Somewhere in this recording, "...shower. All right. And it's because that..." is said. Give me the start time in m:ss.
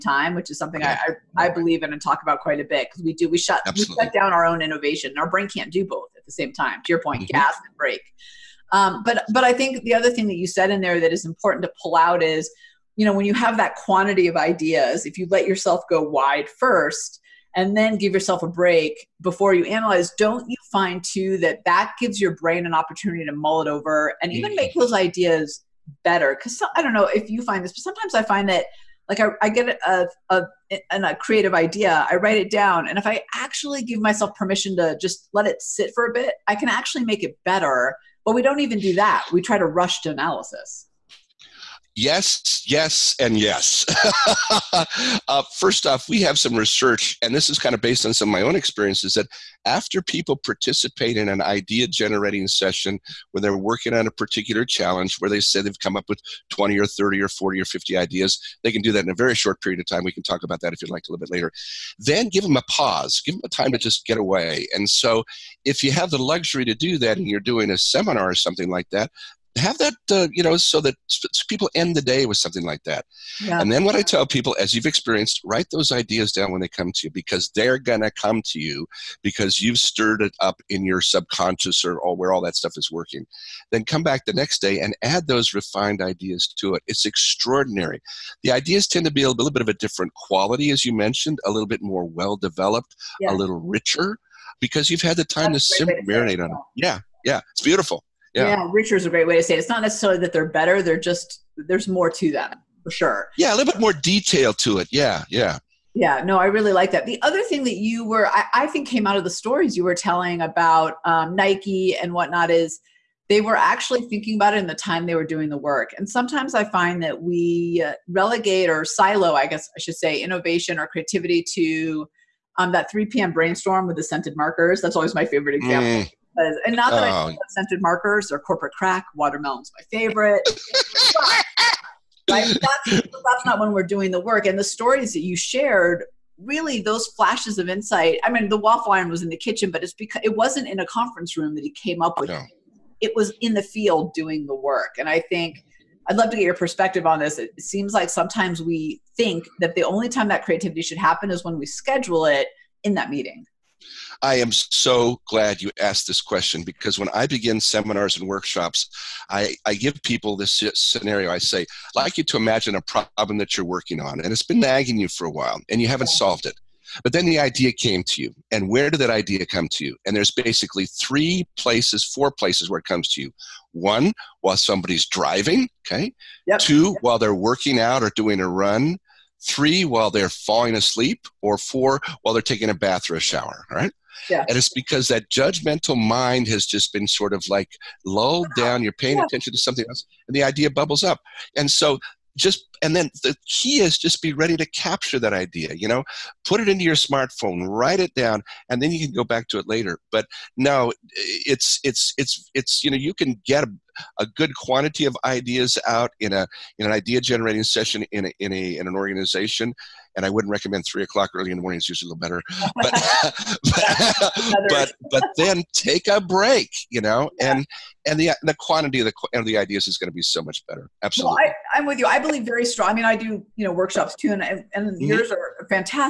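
3:03.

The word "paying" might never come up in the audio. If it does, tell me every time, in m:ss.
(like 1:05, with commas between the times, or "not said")
3:08.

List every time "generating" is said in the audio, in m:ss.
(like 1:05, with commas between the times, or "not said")
0:51, 3:27.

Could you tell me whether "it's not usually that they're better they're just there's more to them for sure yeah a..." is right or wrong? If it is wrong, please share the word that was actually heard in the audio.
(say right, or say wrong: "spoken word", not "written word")
wrong: "necessarily", not "usually".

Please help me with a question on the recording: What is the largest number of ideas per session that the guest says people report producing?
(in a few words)
50.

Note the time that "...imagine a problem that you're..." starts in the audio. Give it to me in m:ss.
2:42.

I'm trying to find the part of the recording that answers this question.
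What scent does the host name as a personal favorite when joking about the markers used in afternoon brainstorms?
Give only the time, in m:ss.
2:09.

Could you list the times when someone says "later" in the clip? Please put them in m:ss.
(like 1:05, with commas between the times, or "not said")
1:01, 3:19.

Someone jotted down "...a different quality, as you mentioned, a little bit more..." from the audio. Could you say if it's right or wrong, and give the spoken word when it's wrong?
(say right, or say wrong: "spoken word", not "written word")
right.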